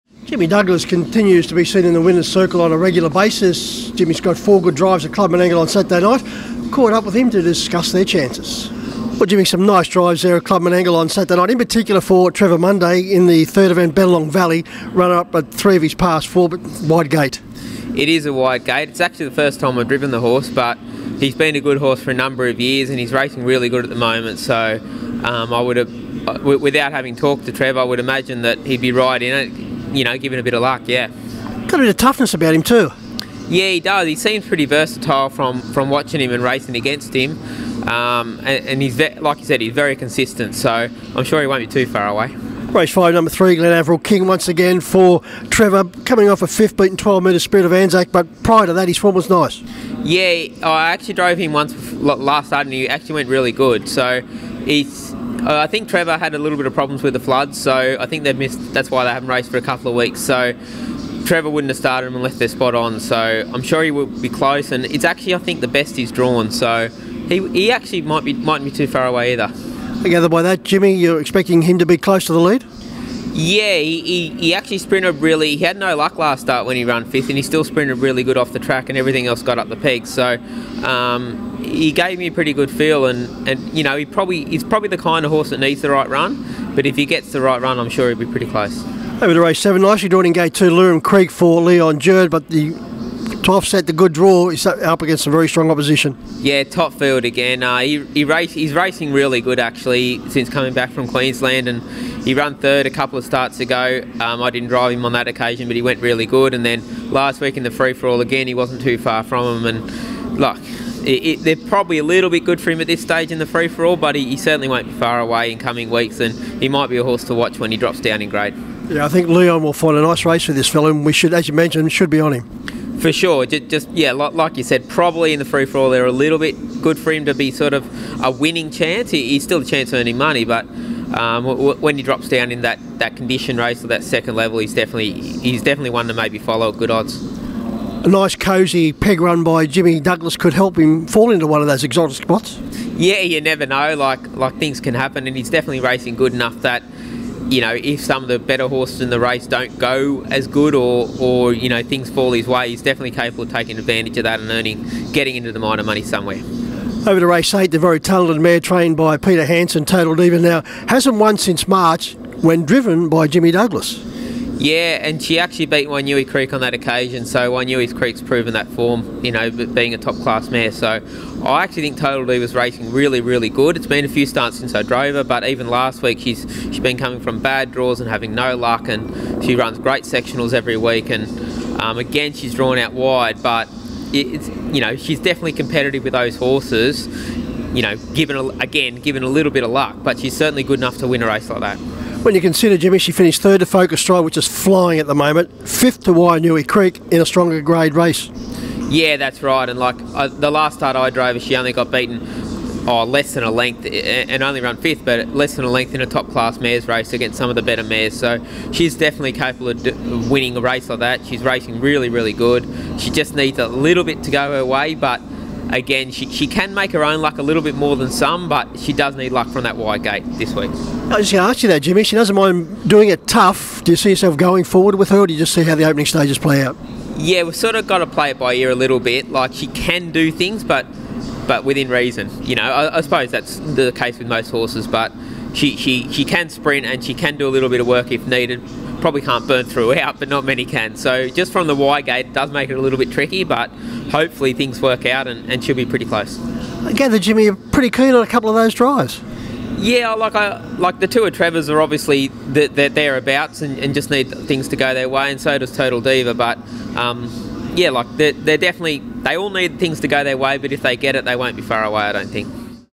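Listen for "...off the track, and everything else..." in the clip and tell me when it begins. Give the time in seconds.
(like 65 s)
78 s.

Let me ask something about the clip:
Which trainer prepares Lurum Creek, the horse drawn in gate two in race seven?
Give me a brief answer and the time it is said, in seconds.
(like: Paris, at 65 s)
Leon Jerd, at 91 s.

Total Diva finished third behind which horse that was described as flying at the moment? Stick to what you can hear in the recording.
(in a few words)
Focus Stride.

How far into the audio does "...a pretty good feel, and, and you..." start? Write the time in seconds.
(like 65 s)
82 s.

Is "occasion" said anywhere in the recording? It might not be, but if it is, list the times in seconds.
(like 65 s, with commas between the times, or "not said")
105 s, 166 s.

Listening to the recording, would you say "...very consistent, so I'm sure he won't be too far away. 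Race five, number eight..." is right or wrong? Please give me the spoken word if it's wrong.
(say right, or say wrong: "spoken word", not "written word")
wrong: "three", not "eight".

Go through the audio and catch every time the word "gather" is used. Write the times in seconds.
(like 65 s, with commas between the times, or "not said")
70 s, 246 s.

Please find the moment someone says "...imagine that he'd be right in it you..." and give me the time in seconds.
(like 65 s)
27 s.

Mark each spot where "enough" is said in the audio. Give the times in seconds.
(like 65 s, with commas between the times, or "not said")
146 s, 190 s.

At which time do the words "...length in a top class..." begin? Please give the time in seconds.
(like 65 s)
205 s.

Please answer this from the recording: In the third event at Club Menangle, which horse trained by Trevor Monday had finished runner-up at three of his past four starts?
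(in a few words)
Benelong Valley.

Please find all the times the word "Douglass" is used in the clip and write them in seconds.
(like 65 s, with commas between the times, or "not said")
0 s, 139 s, 163 s.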